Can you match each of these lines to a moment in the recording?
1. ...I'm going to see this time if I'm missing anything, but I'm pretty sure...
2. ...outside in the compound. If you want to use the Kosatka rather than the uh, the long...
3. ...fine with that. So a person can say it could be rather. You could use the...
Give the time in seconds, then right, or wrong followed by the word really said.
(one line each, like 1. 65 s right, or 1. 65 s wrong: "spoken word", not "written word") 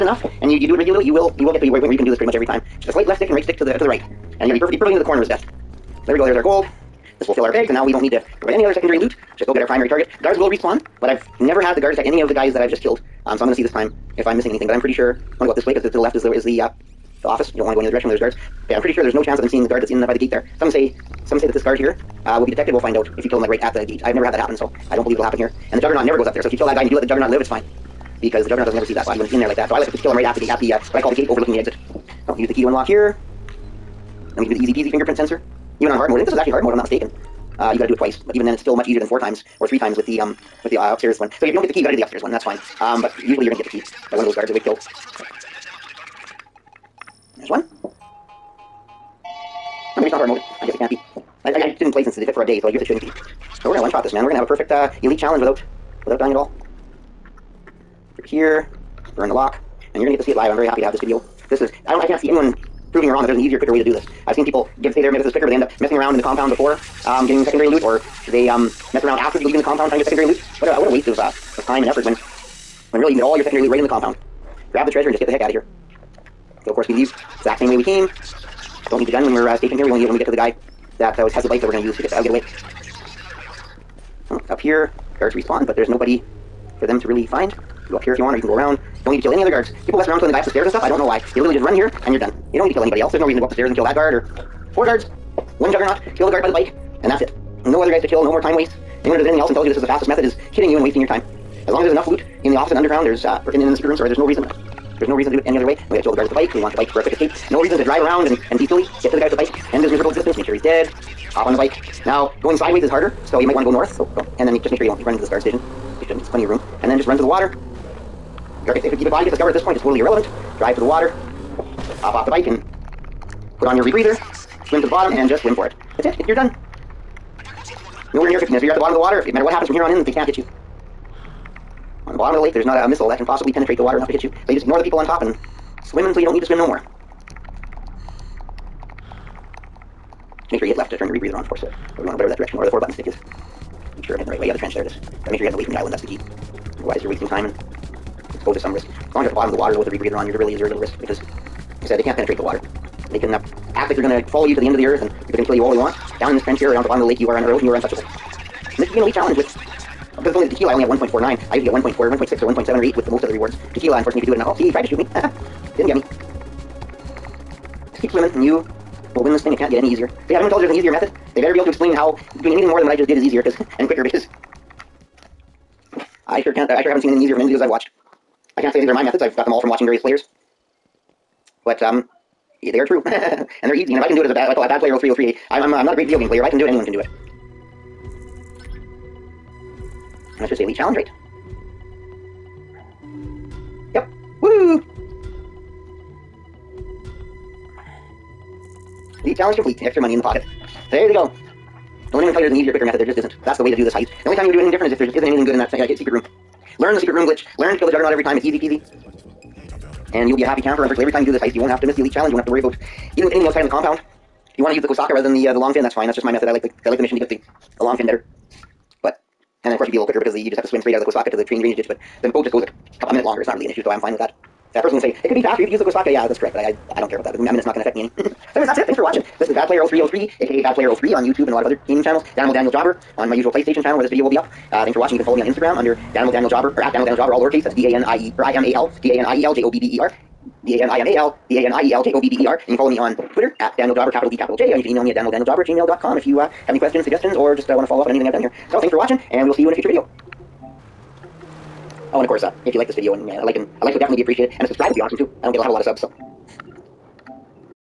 1. 13 s right
2. 213 s right
3. 223 s wrong: "faster", not "rather".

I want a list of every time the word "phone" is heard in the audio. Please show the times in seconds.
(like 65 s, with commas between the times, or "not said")
not said.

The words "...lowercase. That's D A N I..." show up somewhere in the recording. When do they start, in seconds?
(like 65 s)
237 s.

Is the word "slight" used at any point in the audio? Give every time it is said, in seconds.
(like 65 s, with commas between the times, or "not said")
2 s.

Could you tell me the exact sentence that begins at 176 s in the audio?
I sure haven't seen anything easier from any of the videos I've watched.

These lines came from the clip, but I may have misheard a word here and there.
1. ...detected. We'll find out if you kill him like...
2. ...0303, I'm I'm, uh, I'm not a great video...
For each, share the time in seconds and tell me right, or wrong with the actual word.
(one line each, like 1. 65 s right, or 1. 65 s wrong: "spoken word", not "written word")
1. 22 s right
2. 184 s right.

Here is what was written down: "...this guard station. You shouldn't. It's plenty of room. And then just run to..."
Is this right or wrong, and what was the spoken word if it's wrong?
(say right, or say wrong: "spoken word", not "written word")
right.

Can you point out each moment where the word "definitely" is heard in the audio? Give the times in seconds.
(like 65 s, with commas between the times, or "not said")
254 s.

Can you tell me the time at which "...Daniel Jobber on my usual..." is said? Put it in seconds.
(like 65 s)
232 s.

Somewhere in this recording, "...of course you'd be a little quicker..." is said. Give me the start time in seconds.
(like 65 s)
219 s.